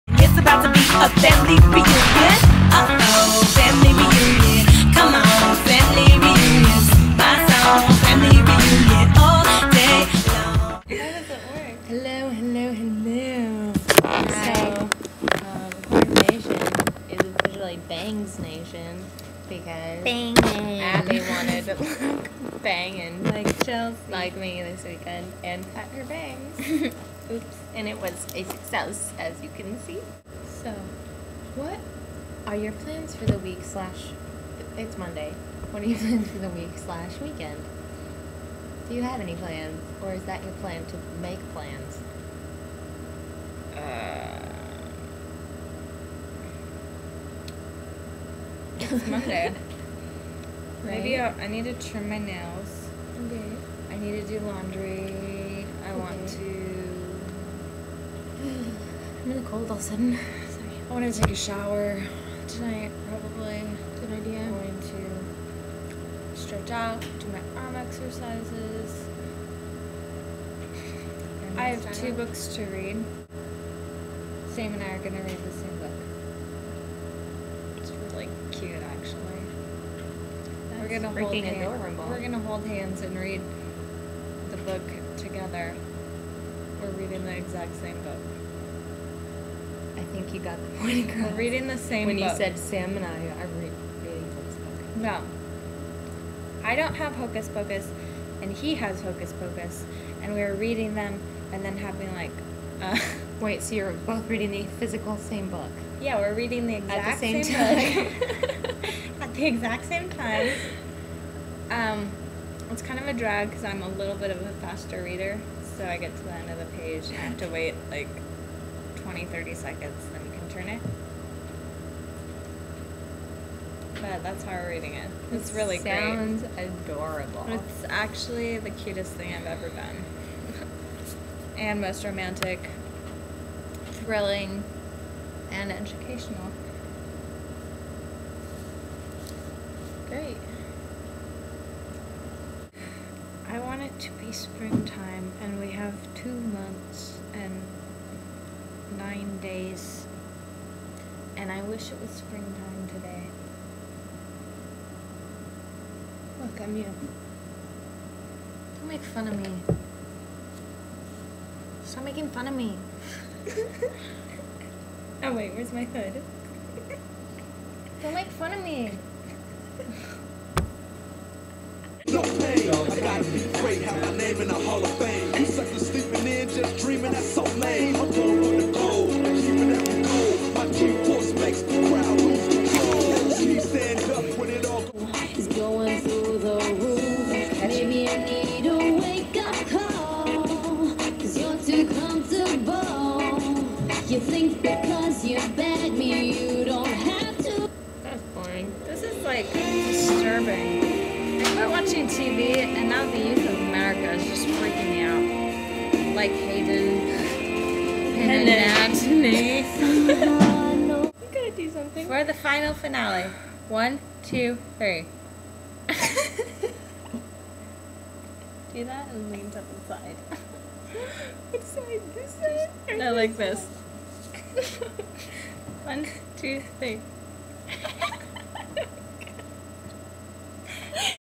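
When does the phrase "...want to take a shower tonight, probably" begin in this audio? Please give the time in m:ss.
1:00.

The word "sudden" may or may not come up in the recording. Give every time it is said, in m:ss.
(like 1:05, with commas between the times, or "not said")
0:59.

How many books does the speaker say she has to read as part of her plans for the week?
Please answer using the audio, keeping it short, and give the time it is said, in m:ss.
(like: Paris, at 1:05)
2, at 1:11.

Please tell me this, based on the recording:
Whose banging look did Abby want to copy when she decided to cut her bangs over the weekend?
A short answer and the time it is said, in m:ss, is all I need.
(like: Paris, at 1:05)
Chelsea, at 0:23.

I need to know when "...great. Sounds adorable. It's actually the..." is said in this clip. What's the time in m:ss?
2:06.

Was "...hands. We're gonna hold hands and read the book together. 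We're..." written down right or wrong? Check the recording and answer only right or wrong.
right.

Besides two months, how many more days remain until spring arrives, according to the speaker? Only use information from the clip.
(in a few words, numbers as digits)
9.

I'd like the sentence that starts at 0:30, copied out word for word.
So, what are your plans for the week slash, it's Monday.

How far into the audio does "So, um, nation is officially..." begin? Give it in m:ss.
0:15.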